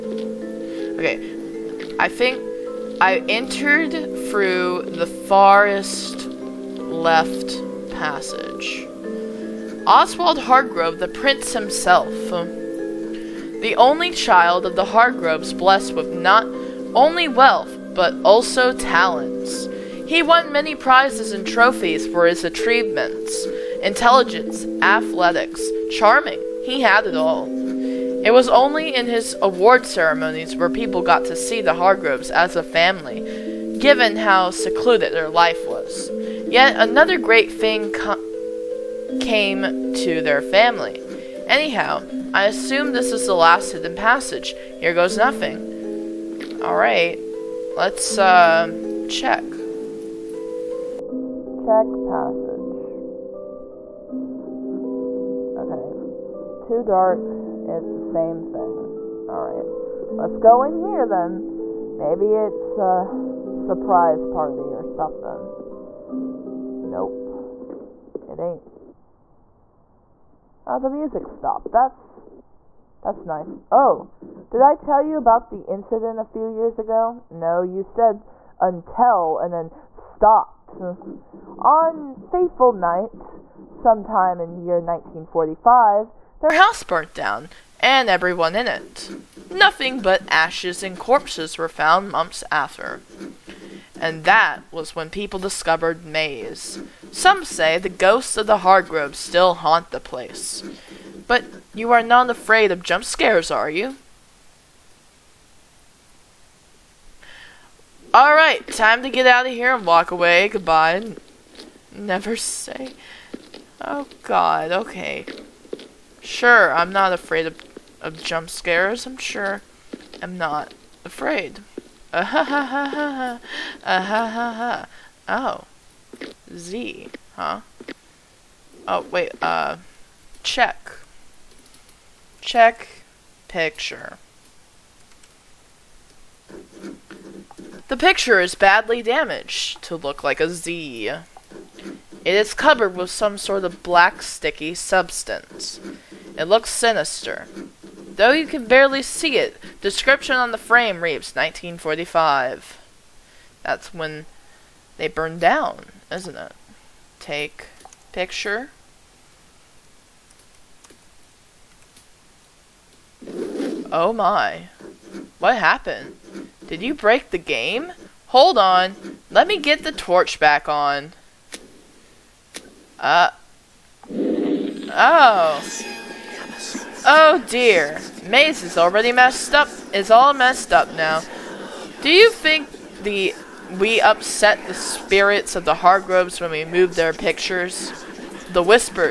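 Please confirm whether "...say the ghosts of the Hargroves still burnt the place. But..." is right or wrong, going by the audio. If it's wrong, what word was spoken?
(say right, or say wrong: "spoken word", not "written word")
wrong: "haunt", not "burnt".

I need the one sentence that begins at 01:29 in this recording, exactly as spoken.
Nothing but ashes and corpses were found months after.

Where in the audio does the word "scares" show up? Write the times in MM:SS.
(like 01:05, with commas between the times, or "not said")
01:43, 01:58.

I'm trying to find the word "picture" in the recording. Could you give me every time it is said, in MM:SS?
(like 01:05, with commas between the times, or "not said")
02:13, 02:17, 02:38, 03:07.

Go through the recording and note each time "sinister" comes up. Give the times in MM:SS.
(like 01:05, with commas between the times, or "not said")
02:26.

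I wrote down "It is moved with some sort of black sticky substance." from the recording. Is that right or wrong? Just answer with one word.
wrong.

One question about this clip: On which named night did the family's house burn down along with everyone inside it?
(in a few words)
Faithful Night.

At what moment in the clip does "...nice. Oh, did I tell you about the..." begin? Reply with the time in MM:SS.
01:13.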